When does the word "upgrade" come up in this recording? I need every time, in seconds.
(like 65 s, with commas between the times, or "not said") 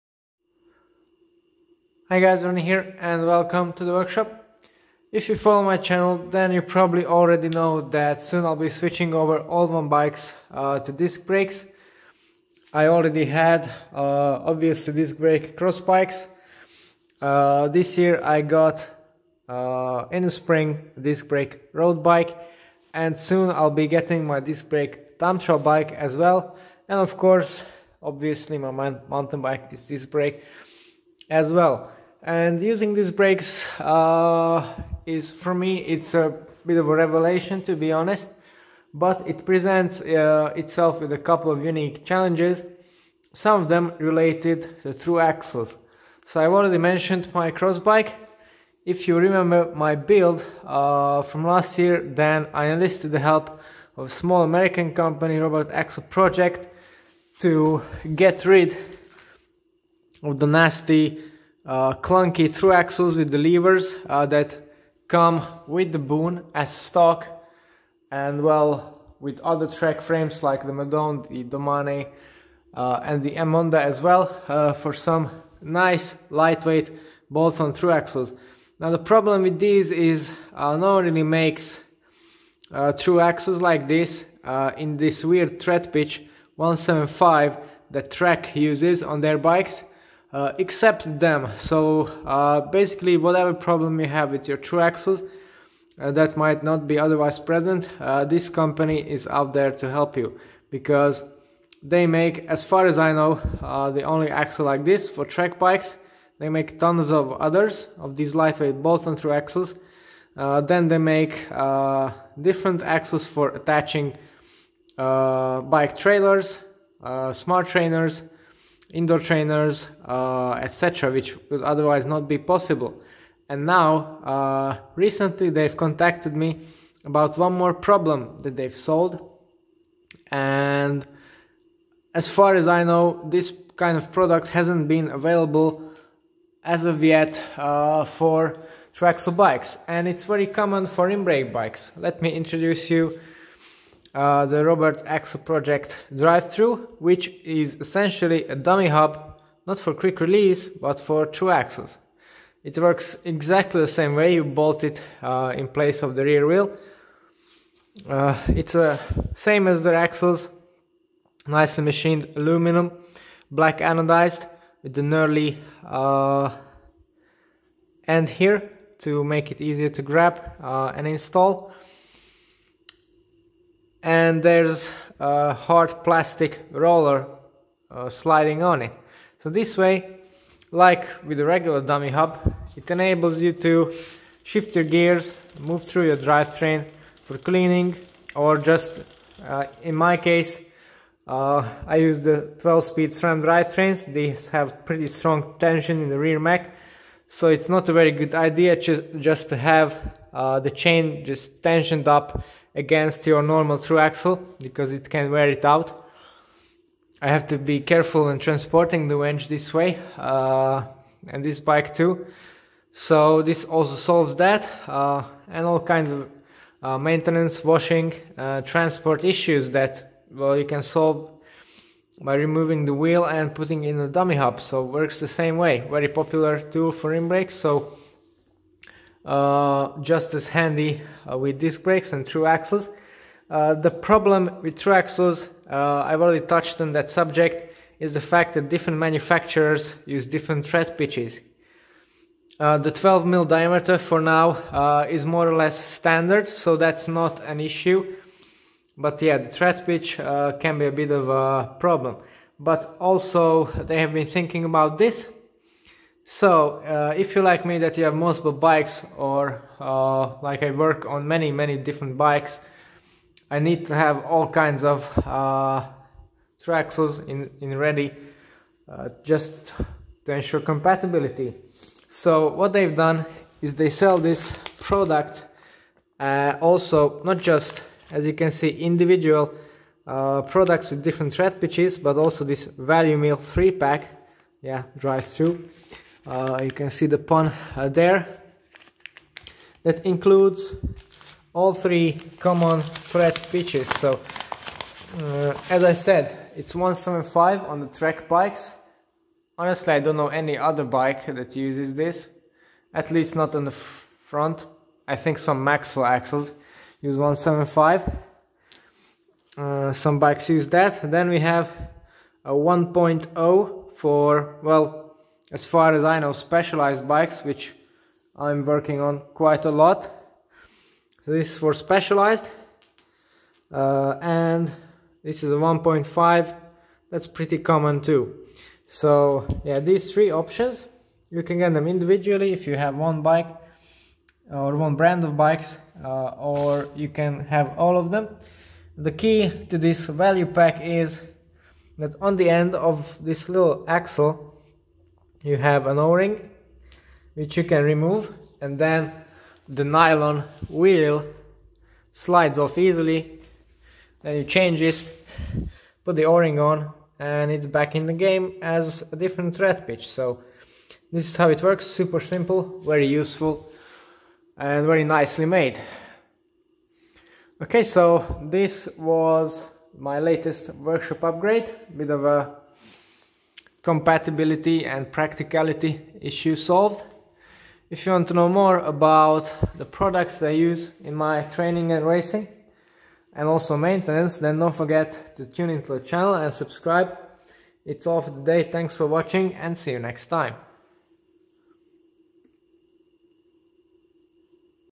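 371 s.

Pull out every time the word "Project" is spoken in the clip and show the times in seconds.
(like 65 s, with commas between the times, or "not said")
56 s, 145 s.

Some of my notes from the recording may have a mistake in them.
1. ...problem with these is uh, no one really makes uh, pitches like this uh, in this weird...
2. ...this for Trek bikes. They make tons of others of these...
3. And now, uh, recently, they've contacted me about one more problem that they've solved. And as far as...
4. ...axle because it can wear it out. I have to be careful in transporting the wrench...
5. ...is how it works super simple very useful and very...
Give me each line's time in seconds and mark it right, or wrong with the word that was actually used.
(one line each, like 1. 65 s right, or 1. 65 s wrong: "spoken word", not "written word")
1. 78 s wrong: "axles", not "pitches"
2. 104 s right
3. 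123 s right
4. 203 s right
5. 361 s right.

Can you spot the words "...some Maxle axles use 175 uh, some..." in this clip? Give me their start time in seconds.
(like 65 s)
305 s.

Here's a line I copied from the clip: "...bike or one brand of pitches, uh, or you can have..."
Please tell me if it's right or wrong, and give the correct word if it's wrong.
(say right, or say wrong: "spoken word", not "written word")
wrong: "bikes", not "pitches".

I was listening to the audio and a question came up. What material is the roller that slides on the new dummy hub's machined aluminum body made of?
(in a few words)
hard plastic.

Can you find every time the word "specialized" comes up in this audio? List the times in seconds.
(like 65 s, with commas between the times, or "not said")
316 s, 321 s.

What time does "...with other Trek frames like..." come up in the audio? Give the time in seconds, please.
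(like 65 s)
69 s.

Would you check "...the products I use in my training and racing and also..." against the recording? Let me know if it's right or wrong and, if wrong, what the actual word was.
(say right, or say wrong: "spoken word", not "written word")
right.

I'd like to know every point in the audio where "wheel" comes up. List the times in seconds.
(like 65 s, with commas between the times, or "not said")
156 s, 222 s, 350 s.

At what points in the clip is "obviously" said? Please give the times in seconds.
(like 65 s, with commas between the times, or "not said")
14 s, 28 s.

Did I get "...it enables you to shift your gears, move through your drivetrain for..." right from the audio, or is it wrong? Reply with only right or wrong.
right.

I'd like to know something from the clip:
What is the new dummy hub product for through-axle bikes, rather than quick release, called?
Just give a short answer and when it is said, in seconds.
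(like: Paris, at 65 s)
drive-through, at 146 s.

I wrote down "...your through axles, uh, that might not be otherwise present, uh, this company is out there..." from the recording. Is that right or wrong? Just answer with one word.
right.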